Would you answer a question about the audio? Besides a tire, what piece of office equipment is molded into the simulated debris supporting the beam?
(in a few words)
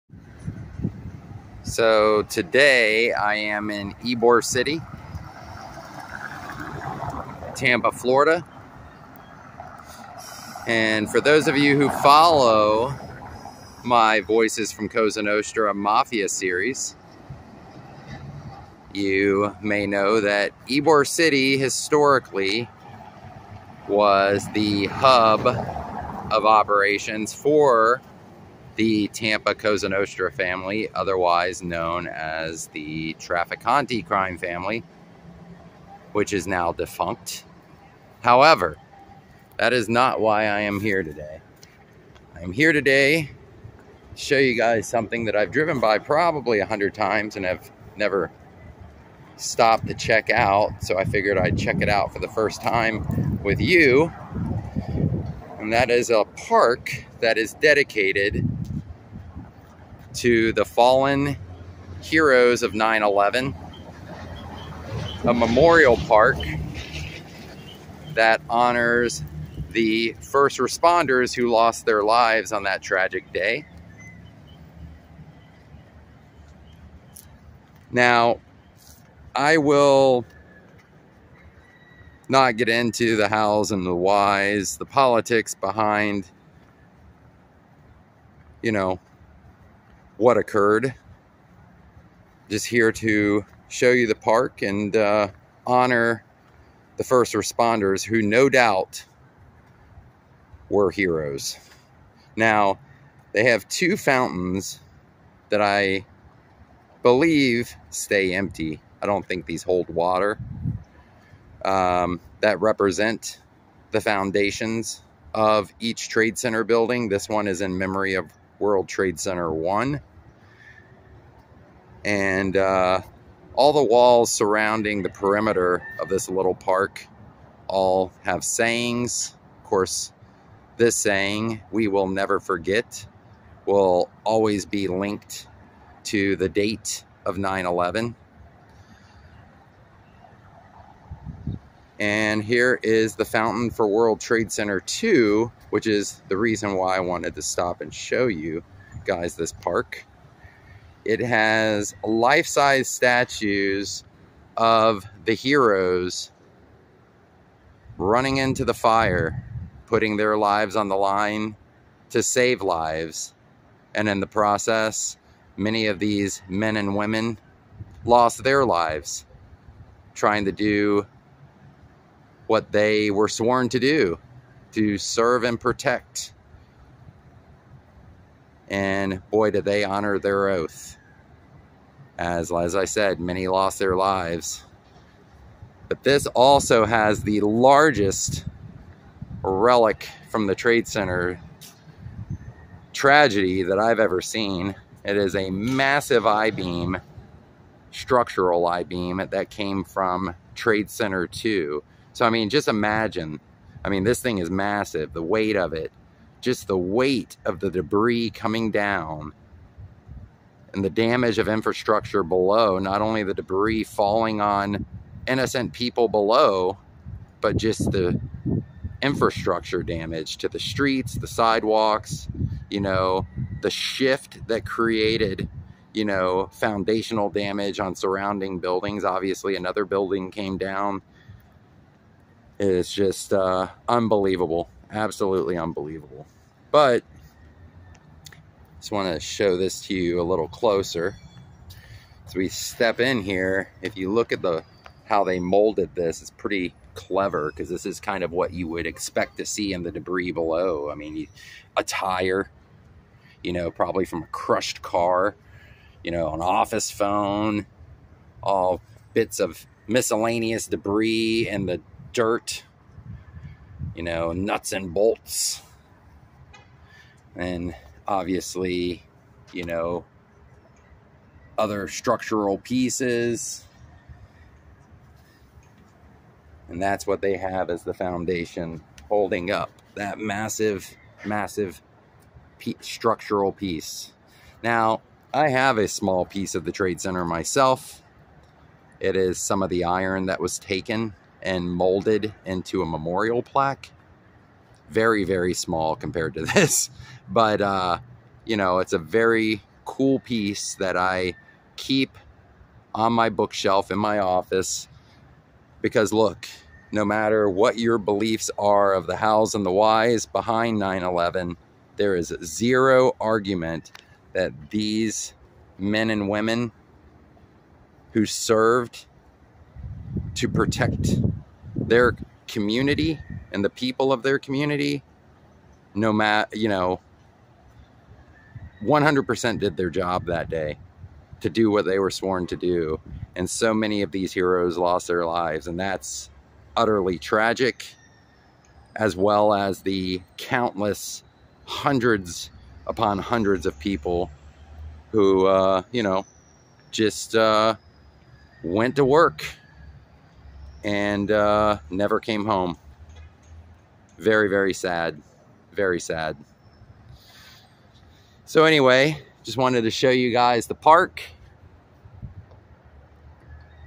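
An office phone.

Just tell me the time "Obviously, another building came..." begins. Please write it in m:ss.
3:49.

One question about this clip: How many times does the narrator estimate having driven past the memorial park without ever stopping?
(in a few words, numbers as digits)
100.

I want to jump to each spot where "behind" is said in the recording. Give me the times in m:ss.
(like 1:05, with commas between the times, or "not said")
1:25, 5:10.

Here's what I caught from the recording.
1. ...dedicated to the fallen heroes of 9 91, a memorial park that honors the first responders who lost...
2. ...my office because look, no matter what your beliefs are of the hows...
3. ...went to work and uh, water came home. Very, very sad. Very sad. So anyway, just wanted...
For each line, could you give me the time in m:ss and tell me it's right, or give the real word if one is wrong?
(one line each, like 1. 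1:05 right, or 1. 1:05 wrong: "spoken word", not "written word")
1. 0:57 wrong: "11", not "91"
2. 5:03 right
3. 5:48 wrong: "never", not "water".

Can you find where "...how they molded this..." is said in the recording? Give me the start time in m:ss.
4:05.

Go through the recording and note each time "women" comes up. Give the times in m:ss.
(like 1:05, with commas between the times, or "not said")
2:46, 5:16.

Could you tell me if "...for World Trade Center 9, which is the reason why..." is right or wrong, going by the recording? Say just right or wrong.
wrong.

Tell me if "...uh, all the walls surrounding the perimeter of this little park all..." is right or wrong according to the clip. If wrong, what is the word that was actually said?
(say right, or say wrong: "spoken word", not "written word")
right.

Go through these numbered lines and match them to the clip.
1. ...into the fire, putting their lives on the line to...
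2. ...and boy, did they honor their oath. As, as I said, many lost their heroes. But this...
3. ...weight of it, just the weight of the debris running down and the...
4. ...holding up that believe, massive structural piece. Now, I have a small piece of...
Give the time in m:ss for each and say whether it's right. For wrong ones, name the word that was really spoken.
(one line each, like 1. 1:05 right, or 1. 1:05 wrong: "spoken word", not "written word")
1. 2:38 right
2. 2:58 wrong: "lives", not "heroes"
3. 3:25 wrong: "coming", not "running"
4. 4:39 wrong: "massive", not "believe".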